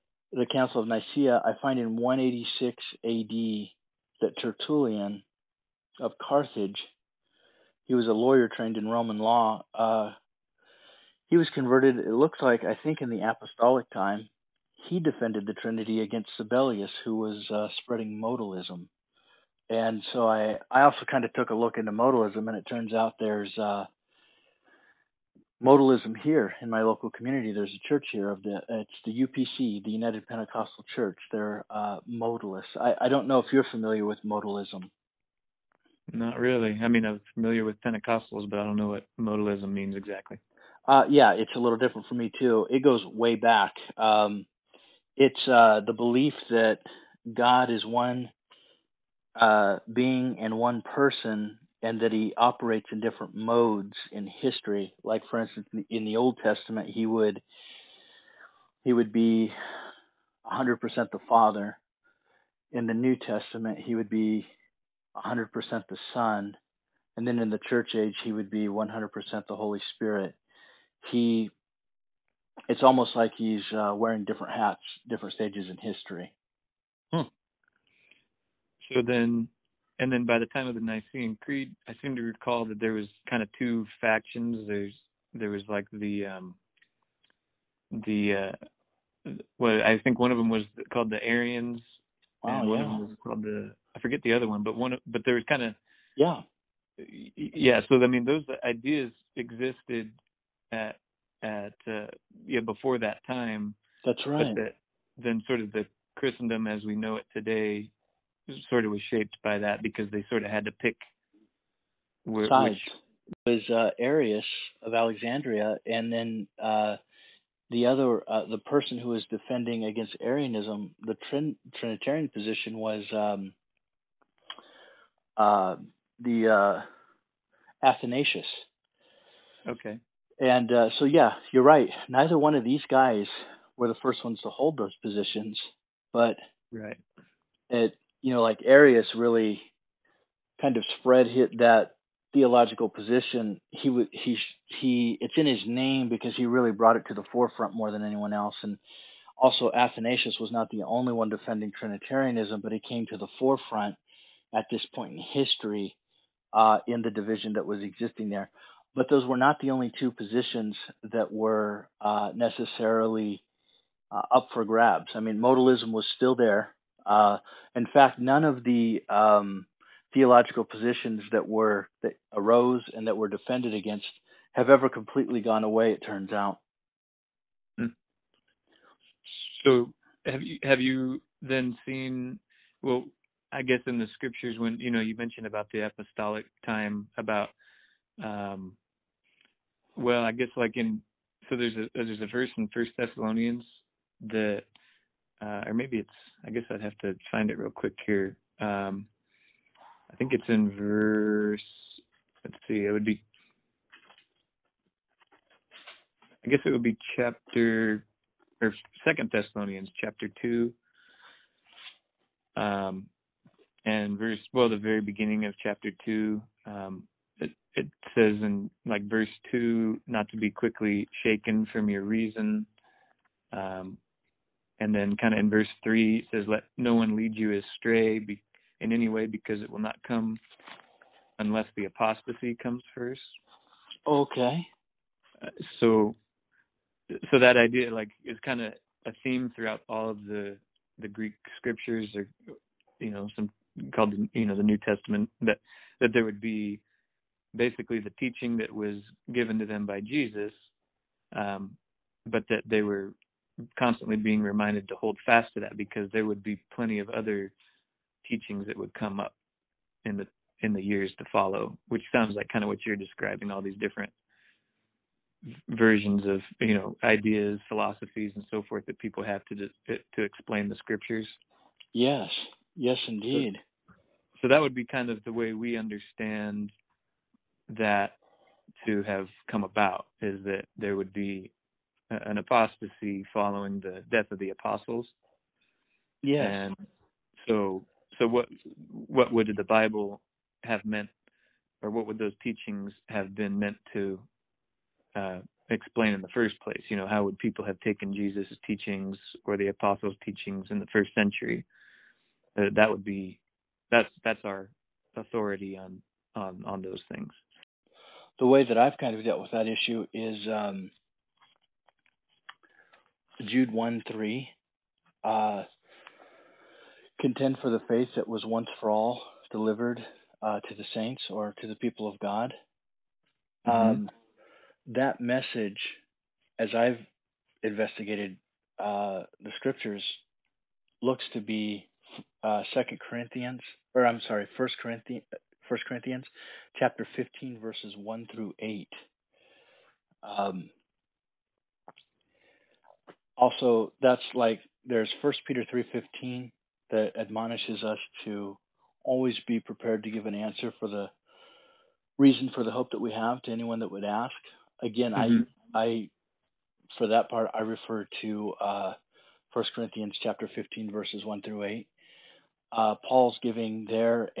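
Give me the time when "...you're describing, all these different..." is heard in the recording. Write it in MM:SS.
04:22.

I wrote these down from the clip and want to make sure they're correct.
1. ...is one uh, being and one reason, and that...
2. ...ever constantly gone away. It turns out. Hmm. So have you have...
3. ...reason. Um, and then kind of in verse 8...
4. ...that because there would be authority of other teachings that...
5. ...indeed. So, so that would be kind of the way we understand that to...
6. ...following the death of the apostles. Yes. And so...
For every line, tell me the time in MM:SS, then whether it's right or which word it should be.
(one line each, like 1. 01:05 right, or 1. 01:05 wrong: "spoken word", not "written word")
1. 00:47 wrong: "person", not "reason"
2. 02:54 wrong: "completely", not "constantly"
3. 03:42 wrong: "3", not "8"
4. 04:15 wrong: "plenty", not "authority"
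5. 04:33 right
6. 04:43 right.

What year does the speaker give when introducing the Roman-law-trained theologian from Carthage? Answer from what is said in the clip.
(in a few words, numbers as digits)
186 AD.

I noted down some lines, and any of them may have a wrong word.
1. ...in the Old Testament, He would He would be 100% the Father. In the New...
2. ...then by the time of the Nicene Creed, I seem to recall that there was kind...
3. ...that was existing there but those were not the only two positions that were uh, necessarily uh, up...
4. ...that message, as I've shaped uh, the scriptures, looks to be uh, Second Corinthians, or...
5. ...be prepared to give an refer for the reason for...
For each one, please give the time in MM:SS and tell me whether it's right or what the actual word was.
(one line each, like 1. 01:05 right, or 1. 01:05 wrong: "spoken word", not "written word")
1. 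00:55 right
2. 01:20 right
3. 02:37 right
4. 05:24 wrong: "investigated", not "shaped"
5. 05:49 wrong: "answer", not "refer".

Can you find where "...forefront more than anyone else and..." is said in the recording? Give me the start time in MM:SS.
02:27.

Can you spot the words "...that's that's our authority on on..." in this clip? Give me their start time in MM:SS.
05:03.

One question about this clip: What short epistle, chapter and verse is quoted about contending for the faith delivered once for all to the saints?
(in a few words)
Jude 1:3.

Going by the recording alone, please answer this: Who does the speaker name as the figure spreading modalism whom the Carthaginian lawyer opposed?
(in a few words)
Sabellius.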